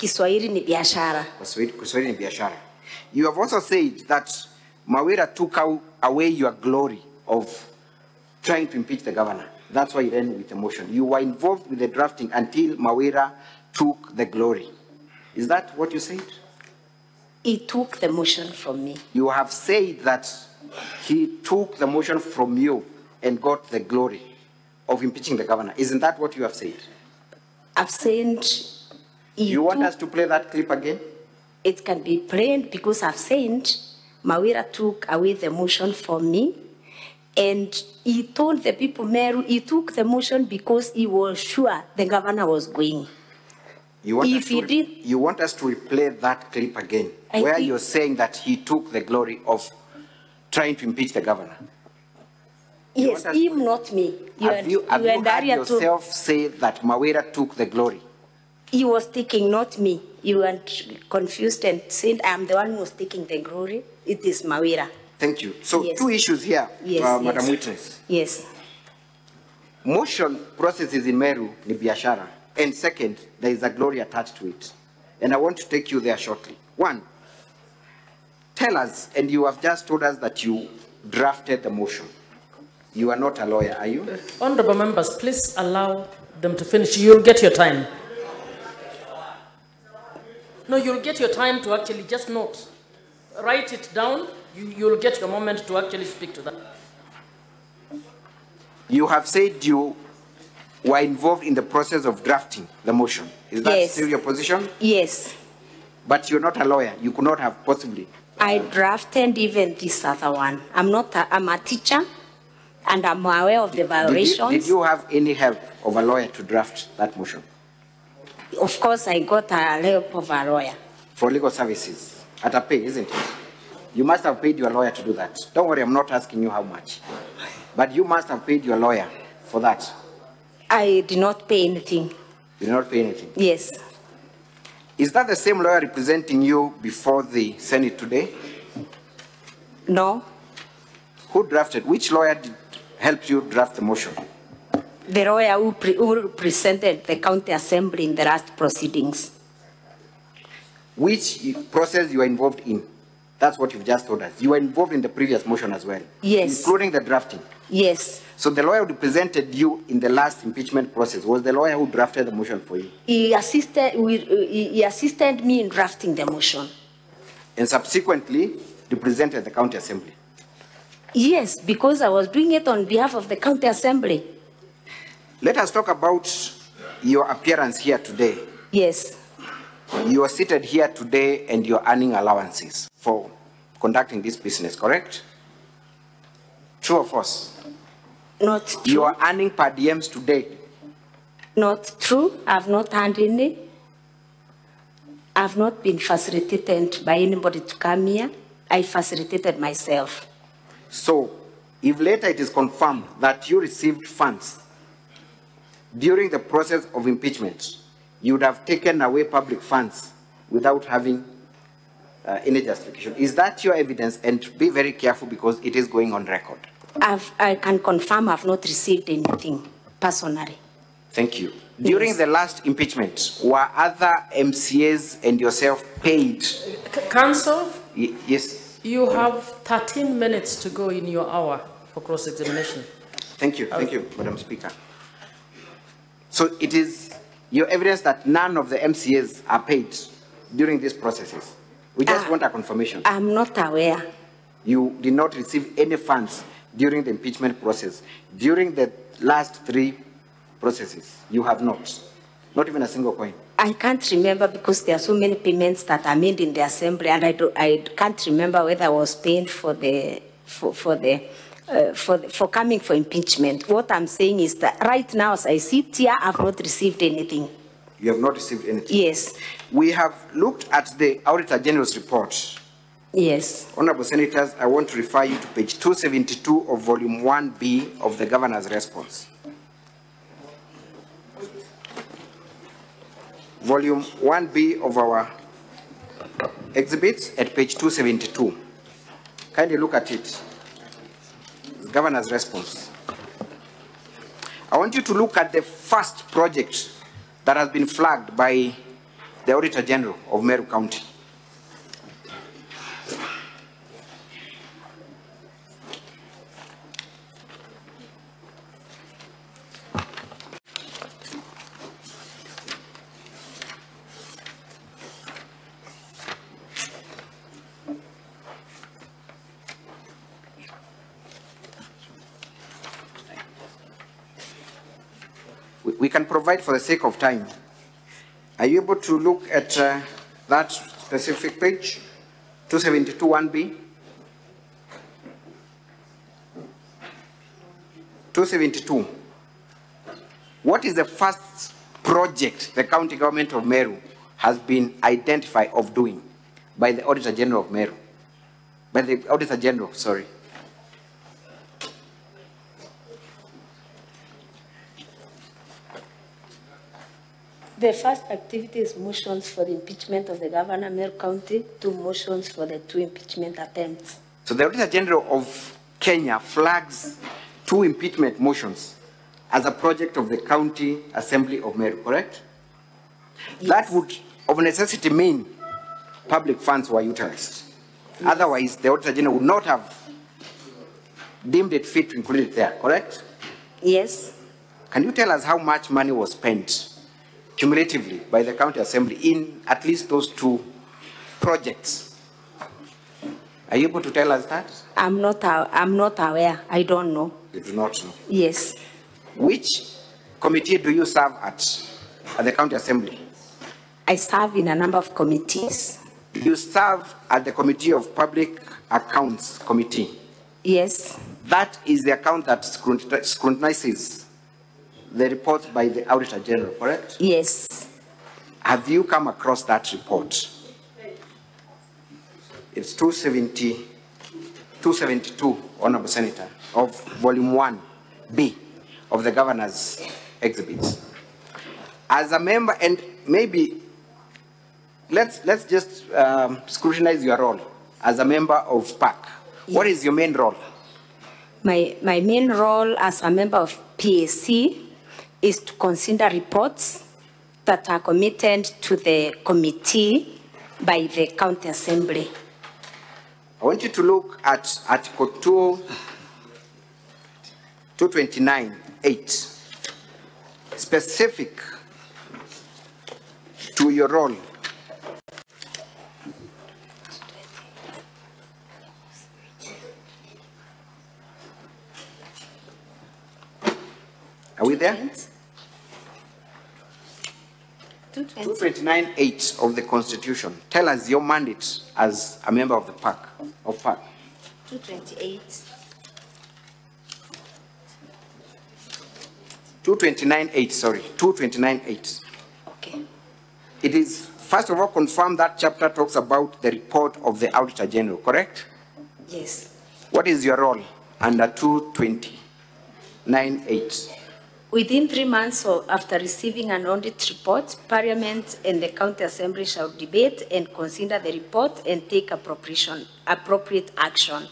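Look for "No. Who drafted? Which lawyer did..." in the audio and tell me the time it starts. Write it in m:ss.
2:19.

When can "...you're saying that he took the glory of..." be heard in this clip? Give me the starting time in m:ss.
0:47.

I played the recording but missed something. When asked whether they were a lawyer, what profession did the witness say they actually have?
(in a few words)
Teacher.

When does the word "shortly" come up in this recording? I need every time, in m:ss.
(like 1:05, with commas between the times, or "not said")
1:16.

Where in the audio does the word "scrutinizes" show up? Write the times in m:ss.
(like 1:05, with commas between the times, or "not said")
6:52, 7:16.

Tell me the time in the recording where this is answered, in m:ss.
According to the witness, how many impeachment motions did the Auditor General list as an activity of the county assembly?
6:01.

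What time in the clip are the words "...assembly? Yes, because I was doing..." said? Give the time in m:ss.
2:49.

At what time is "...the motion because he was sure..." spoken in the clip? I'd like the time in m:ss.
0:39.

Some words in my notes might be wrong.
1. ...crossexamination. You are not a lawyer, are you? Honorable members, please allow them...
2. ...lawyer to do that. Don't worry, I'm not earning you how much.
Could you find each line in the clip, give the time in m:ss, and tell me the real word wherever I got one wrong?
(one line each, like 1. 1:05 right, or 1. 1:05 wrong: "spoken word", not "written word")
1. 1:21 wrong: "motion", not "crossexamination"
2. 2:04 wrong: "asking", not "earning".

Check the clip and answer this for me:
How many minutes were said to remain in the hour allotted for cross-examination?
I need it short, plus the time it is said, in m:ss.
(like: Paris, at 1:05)
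13, at 3:49.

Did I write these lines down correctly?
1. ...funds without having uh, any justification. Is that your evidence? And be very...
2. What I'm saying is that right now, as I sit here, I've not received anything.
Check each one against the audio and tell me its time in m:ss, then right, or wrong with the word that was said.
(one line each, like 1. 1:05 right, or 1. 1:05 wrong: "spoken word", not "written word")
1. 3:29 right
2. 4:23 right.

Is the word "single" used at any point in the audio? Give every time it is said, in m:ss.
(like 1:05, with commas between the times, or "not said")
4:12.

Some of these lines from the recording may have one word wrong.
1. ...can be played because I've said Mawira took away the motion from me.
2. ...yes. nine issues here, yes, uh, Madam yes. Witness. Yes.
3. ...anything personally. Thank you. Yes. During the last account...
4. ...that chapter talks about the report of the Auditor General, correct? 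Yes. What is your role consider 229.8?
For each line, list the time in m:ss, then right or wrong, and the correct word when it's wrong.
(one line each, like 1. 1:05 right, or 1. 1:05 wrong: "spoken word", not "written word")
1. 0:31 right
2. 1:05 wrong: "two", not "nine"
3. 3:39 wrong: "impeachment", not "account"
4. 8:15 wrong: "under", not "consider".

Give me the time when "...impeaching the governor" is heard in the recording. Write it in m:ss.
0:25.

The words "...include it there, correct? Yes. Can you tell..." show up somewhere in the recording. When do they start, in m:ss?
6:22.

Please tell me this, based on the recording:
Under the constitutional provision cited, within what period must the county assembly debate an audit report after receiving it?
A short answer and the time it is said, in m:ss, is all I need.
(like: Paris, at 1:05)
3 months, at 8:25.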